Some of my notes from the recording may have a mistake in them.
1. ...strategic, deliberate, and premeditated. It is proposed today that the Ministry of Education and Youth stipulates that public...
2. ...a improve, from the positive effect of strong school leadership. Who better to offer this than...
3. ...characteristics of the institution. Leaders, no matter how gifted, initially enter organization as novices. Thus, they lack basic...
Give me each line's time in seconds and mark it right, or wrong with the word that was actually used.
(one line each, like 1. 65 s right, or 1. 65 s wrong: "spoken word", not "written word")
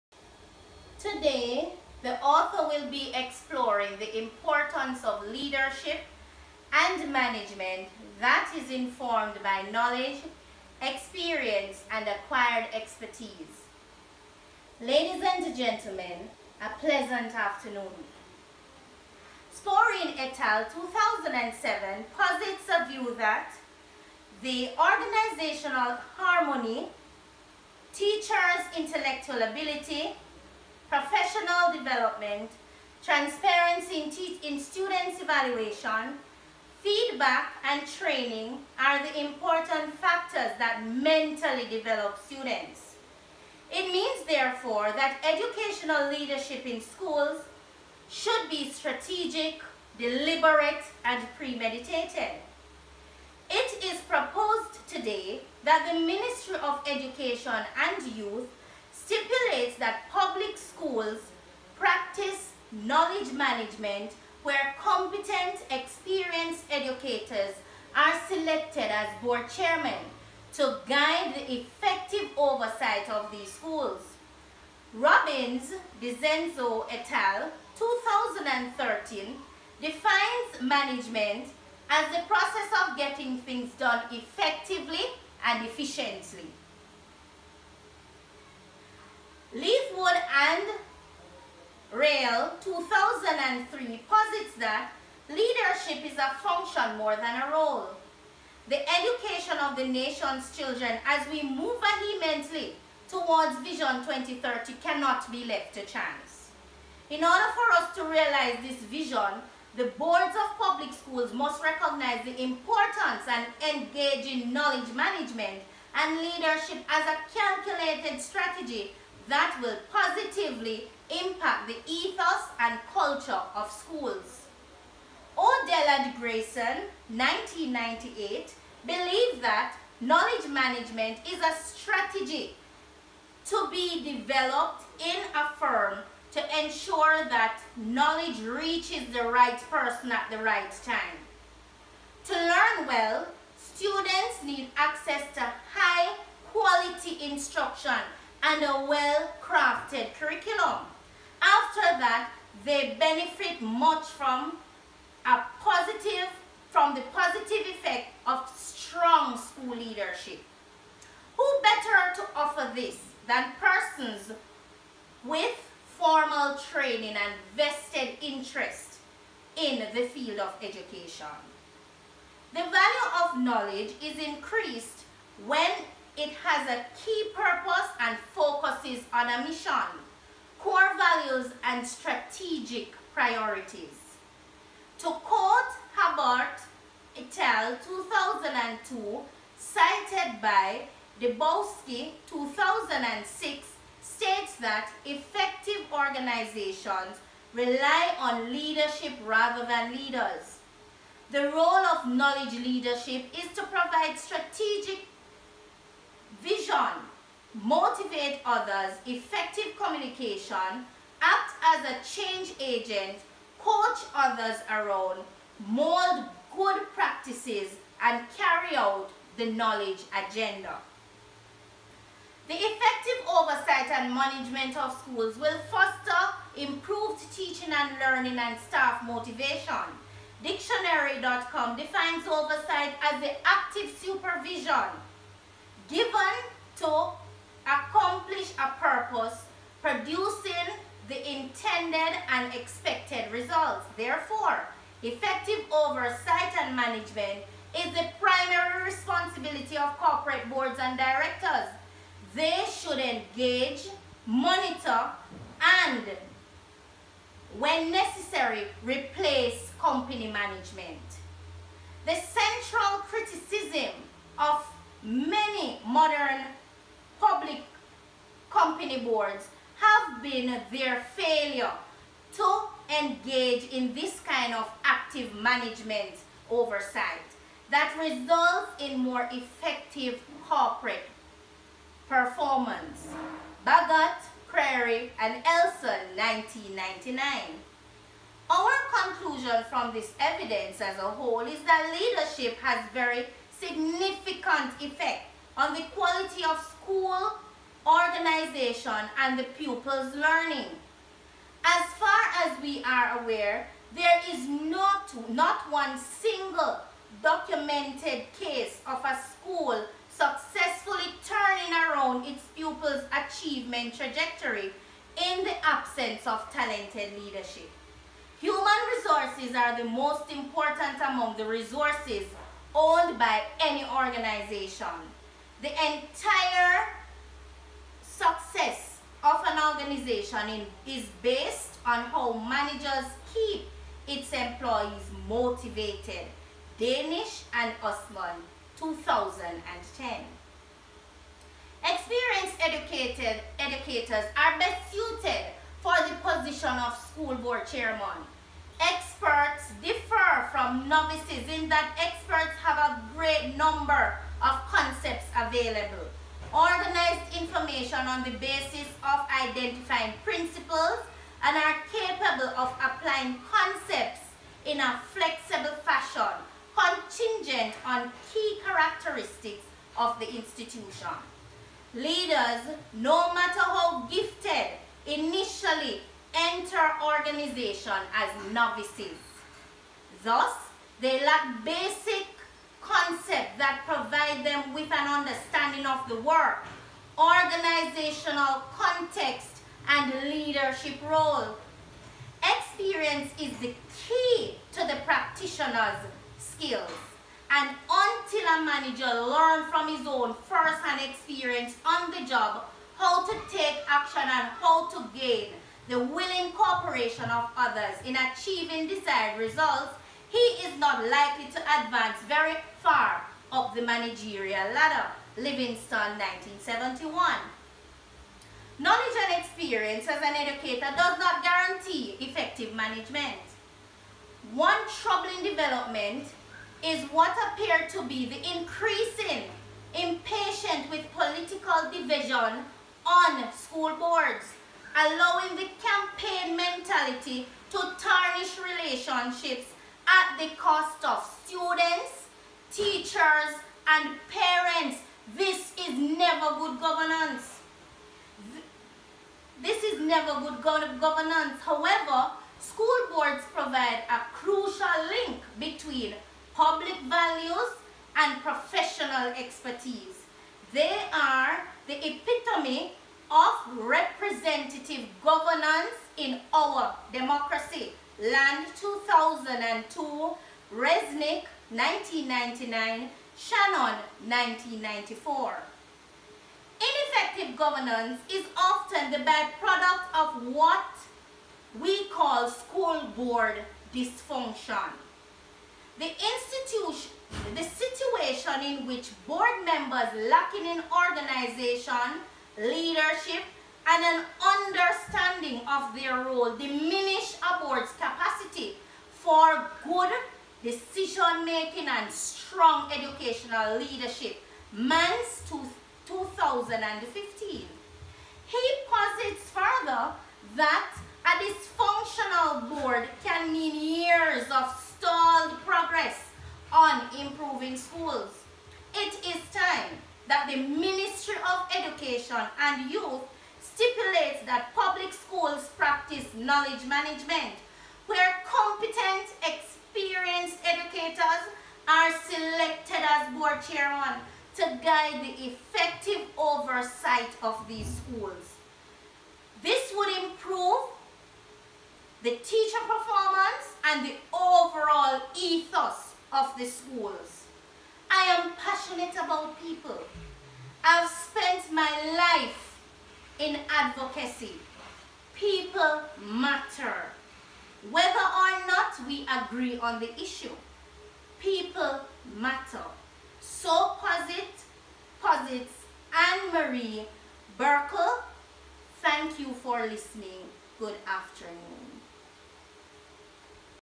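1. 48 s right
2. 155 s wrong: "positive", not "improve"
3. 368 s right.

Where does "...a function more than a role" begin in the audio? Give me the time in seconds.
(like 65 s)
96 s.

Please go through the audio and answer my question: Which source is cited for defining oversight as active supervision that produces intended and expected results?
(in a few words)
Dictionary.com.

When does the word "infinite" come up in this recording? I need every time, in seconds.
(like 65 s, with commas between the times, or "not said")
not said.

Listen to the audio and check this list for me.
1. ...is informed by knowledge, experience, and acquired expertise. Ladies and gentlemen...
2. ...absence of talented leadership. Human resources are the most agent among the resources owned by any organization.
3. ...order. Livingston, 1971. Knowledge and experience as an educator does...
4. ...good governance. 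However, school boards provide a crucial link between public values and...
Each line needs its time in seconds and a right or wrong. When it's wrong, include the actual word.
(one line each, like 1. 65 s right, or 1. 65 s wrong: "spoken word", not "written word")
1. 8 s right
2. 315 s wrong: "important", not "agent"
3. 414 s wrong: "ladder", not "order"
4. 450 s right.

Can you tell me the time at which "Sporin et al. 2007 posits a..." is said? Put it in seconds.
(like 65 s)
19 s.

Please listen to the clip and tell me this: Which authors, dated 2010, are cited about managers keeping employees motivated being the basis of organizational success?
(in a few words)
Danish and Usman.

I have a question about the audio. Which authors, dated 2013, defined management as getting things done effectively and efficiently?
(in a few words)
Robbins, DeCenzo et al.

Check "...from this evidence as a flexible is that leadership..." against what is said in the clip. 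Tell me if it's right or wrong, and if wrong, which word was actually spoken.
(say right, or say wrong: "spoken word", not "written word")
wrong: "whole", not "flexible".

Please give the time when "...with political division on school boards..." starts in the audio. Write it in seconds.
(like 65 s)
430 s.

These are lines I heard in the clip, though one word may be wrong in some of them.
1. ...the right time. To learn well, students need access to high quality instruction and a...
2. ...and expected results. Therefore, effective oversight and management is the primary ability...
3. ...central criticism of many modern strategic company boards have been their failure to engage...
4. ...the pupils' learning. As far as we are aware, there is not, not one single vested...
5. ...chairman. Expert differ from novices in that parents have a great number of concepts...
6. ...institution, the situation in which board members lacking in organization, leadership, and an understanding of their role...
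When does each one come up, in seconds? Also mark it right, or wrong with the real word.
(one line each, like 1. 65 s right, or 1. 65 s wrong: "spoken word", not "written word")
1. 140 s right
2. 242 s wrong: "responsibility", not "ability"
3. 262 s wrong: "public", not "strategic"
4. 299 s wrong: "documented", not "vested"
5. 347 s wrong: "experts", not "parents"
6. 486 s right.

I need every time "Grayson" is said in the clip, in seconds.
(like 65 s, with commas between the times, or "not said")
126 s.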